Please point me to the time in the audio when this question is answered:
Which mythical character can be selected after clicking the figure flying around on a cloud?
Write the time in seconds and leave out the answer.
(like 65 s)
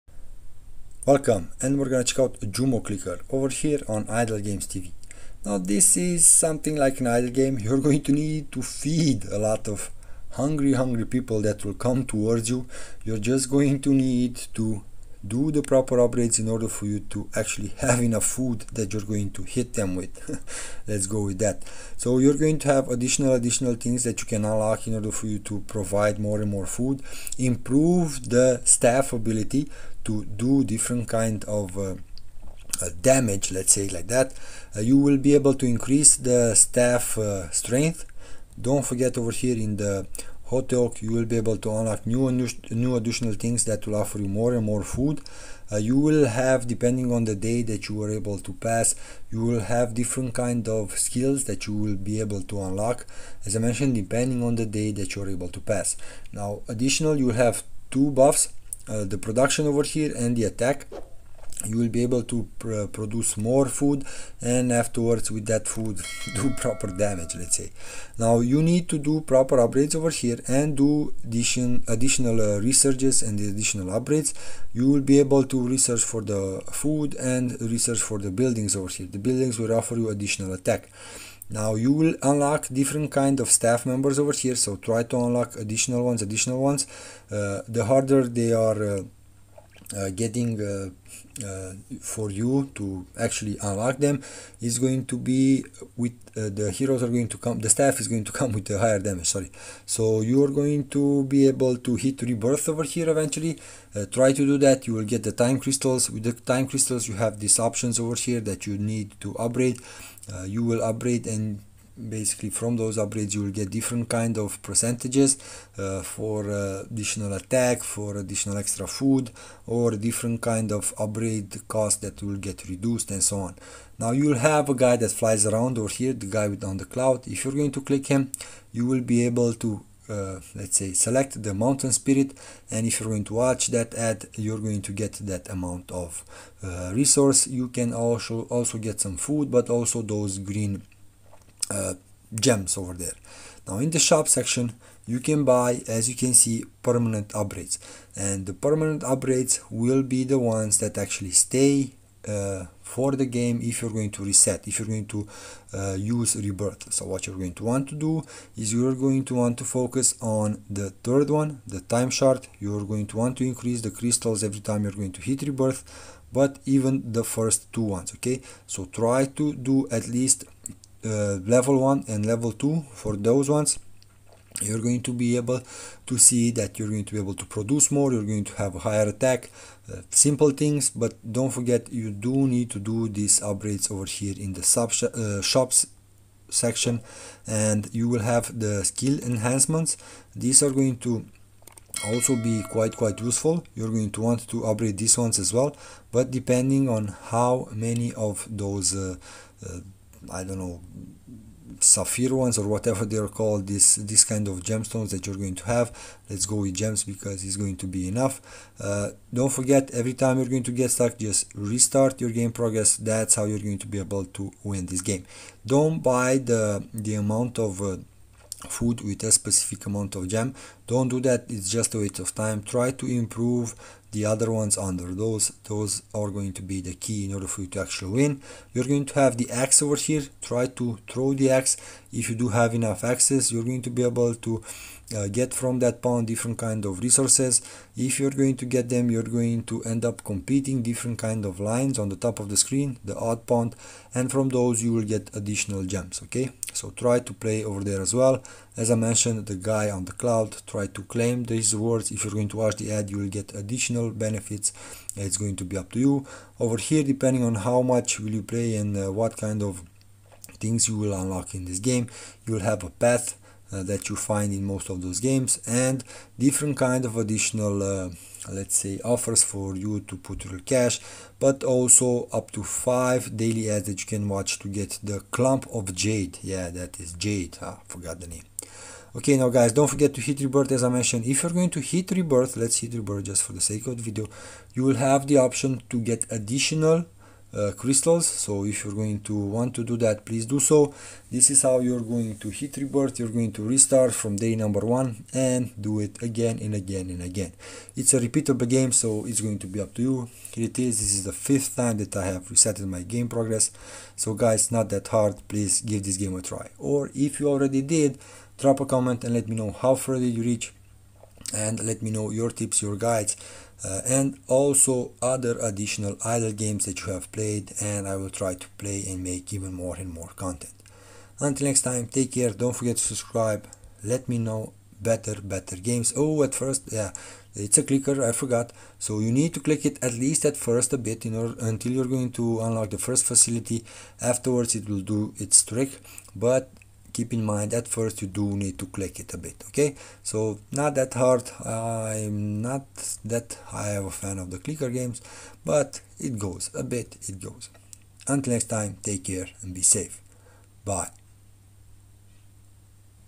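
131 s.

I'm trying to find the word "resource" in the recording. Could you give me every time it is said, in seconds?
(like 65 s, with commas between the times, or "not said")
136 s, 236 s.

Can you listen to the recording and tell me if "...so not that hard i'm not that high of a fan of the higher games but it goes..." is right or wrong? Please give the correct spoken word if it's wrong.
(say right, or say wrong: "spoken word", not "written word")
wrong: "clicker", not "higher".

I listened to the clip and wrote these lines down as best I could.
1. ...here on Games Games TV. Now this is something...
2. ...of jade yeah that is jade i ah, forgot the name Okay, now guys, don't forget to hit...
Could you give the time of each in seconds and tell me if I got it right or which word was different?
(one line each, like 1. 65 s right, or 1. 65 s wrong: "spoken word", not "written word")
1. 3 s wrong: "Idle", not "Games"
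2. 275 s right.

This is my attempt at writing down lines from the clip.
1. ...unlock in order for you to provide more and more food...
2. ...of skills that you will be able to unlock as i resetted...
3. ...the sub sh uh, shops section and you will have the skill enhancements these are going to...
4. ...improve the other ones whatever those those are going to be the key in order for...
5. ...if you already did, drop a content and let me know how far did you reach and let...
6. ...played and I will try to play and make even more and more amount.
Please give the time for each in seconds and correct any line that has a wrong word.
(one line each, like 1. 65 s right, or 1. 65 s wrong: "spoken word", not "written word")
1. 24 s right
2. 50 s wrong: "mentioned", not "resetted"
3. 184 s right
4. 223 s wrong: "under", not "whatever"
5. 307 s wrong: "comment", not "content"
6. 317 s wrong: "content", not "amount".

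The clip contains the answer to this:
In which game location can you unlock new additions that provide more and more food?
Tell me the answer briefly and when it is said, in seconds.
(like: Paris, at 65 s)
Hotel, at 40 s.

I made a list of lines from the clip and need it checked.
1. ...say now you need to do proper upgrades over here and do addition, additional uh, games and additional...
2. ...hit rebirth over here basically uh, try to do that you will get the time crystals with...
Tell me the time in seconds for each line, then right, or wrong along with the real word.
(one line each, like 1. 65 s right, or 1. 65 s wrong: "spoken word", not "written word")
1. 67 s wrong: "researches", not "games"
2. 101 s wrong: "eventually", not "basically".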